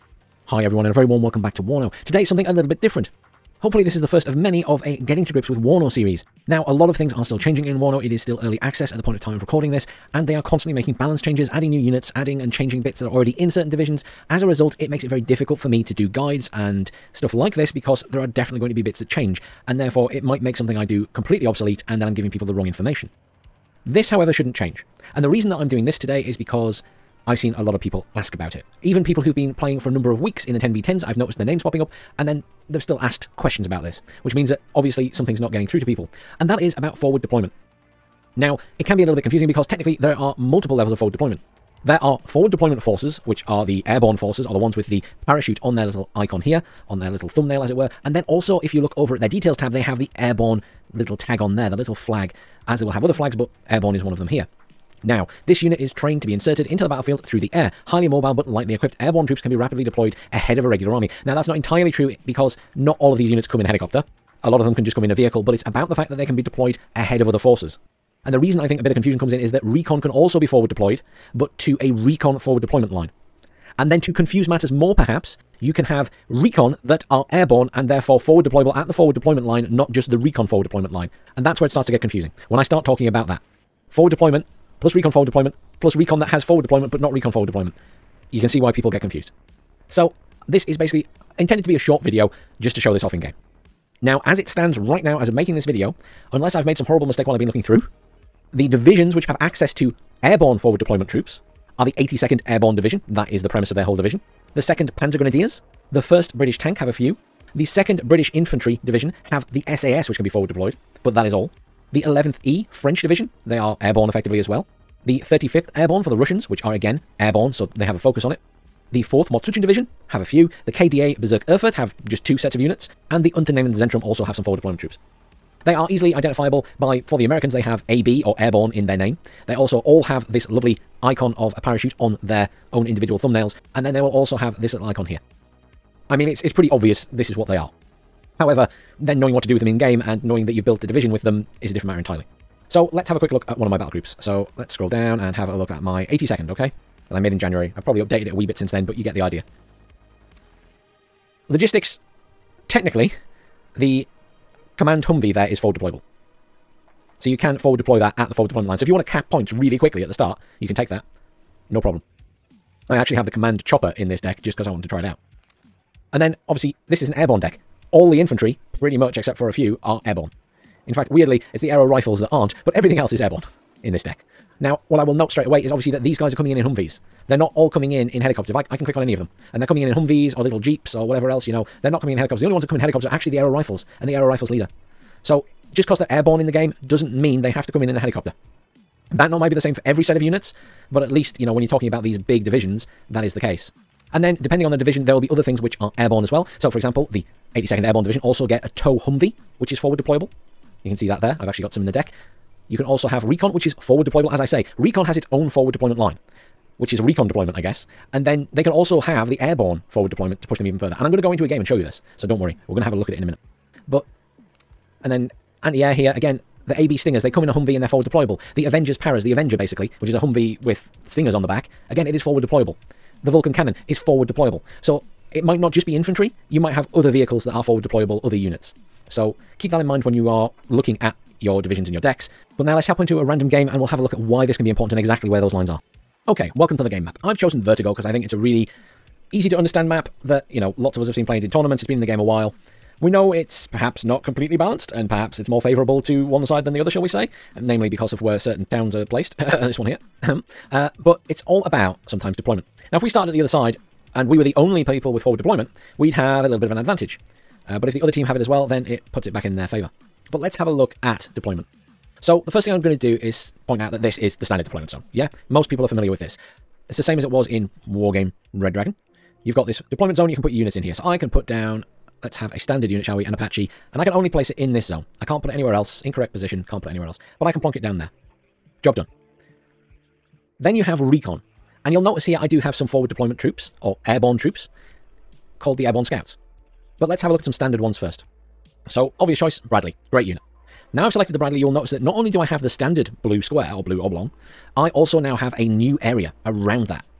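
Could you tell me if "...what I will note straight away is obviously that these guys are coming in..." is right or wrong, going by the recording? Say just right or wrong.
right.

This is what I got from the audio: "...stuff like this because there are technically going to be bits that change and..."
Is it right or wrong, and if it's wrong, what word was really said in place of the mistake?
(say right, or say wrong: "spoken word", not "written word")
wrong: "definitely", not "technically".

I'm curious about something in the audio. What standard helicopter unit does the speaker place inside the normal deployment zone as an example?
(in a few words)
Apache.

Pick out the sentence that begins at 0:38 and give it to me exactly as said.
Now, it can be a little bit confusing because technically there are multiple levels of forward deployment.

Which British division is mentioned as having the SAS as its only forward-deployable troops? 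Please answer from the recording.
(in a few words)
2nd British Infantry Division.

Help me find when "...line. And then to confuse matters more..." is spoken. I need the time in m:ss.
1:12.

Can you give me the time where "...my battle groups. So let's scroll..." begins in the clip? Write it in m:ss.
2:23.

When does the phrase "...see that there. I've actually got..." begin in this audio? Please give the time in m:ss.
3:20.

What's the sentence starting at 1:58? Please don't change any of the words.
The 4th Mot.-Schützen Division have a few.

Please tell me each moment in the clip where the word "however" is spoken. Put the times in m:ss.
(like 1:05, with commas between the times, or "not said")
0:24, 2:18.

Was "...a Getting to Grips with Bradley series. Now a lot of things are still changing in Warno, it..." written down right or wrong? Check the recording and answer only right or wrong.
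wrong.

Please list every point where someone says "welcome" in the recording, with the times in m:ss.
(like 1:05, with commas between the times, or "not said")
0:01, 3:56.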